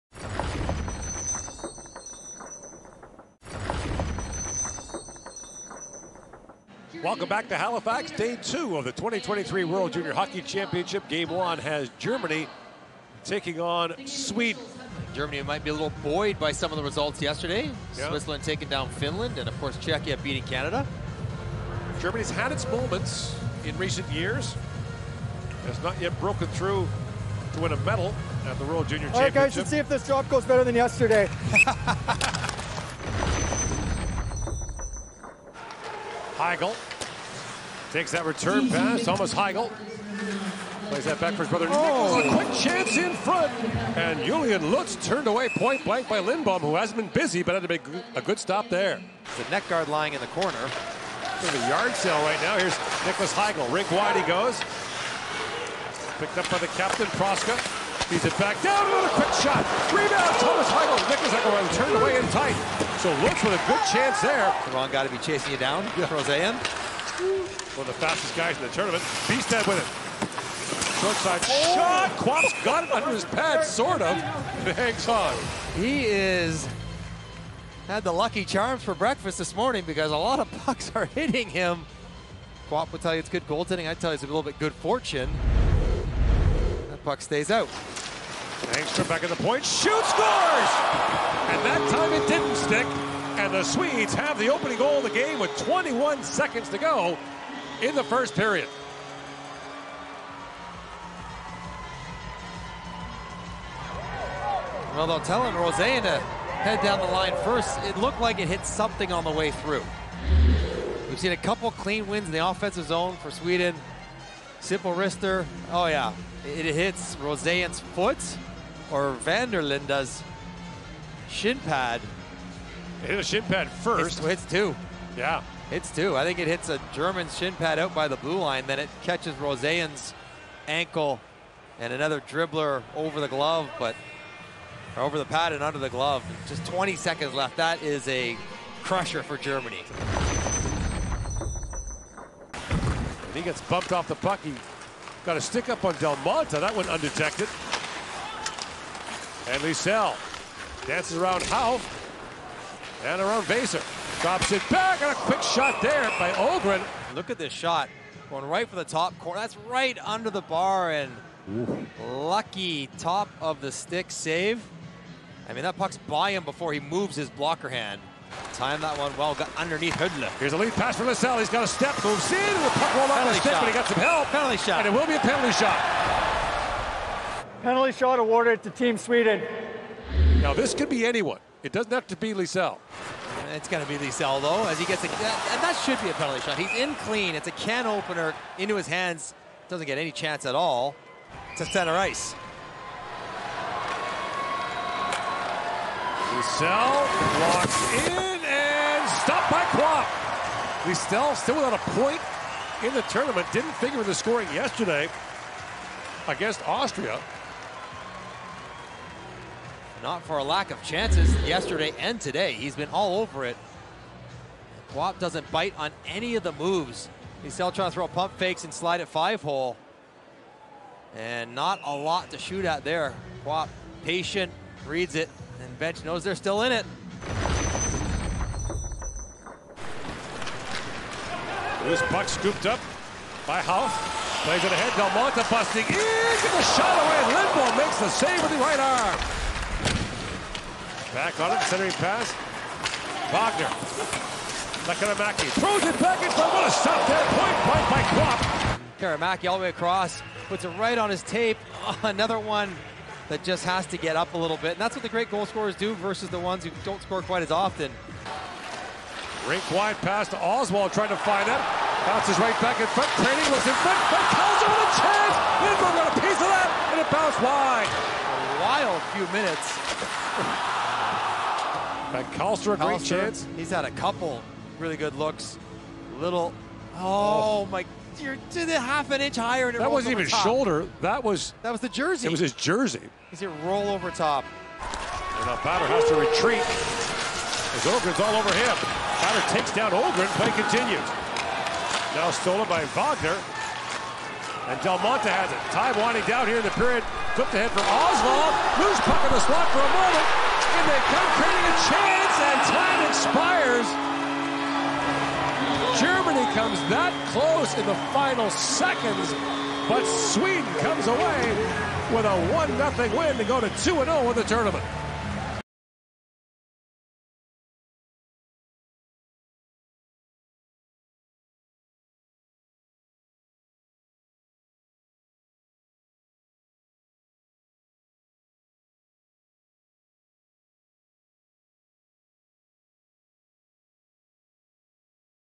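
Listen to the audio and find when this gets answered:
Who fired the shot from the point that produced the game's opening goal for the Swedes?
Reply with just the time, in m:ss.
1:28.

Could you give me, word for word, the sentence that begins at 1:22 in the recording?
Quapp will tell you it's good goaltending.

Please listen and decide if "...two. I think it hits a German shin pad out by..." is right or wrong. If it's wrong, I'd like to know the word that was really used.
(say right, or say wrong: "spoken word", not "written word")
right.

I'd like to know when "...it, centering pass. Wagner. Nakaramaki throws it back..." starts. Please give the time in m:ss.
4:01.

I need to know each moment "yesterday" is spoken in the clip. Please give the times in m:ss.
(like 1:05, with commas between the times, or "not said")
0:17, 0:30, 3:24, 3:31.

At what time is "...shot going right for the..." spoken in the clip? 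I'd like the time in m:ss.
2:37.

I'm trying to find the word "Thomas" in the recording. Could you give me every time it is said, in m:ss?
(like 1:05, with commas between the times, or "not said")
0:39, 1:00.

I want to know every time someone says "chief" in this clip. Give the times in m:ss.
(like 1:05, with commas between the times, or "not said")
not said.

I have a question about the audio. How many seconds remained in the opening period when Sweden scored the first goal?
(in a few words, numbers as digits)
21.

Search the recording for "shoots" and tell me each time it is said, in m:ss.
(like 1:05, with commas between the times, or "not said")
1:29, 3:42.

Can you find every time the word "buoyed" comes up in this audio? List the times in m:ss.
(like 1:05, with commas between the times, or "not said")
0:16.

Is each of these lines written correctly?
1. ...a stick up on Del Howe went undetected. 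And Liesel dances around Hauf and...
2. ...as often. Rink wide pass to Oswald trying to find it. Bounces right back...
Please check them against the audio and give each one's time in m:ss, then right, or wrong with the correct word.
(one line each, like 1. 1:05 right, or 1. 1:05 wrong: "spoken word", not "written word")
1. 2:25 wrong: "That", not "Howe"
2. 4:17 right.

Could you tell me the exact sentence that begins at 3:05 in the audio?
And that should be a penalty shot.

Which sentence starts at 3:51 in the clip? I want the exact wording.
This puck scooped up by Howe.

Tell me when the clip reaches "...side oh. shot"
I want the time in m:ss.
1:11.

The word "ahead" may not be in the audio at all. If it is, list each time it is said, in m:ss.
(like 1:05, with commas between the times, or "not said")
3:54, 4:57.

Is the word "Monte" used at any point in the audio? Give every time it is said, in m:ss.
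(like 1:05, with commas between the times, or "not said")
3:55, 4:54.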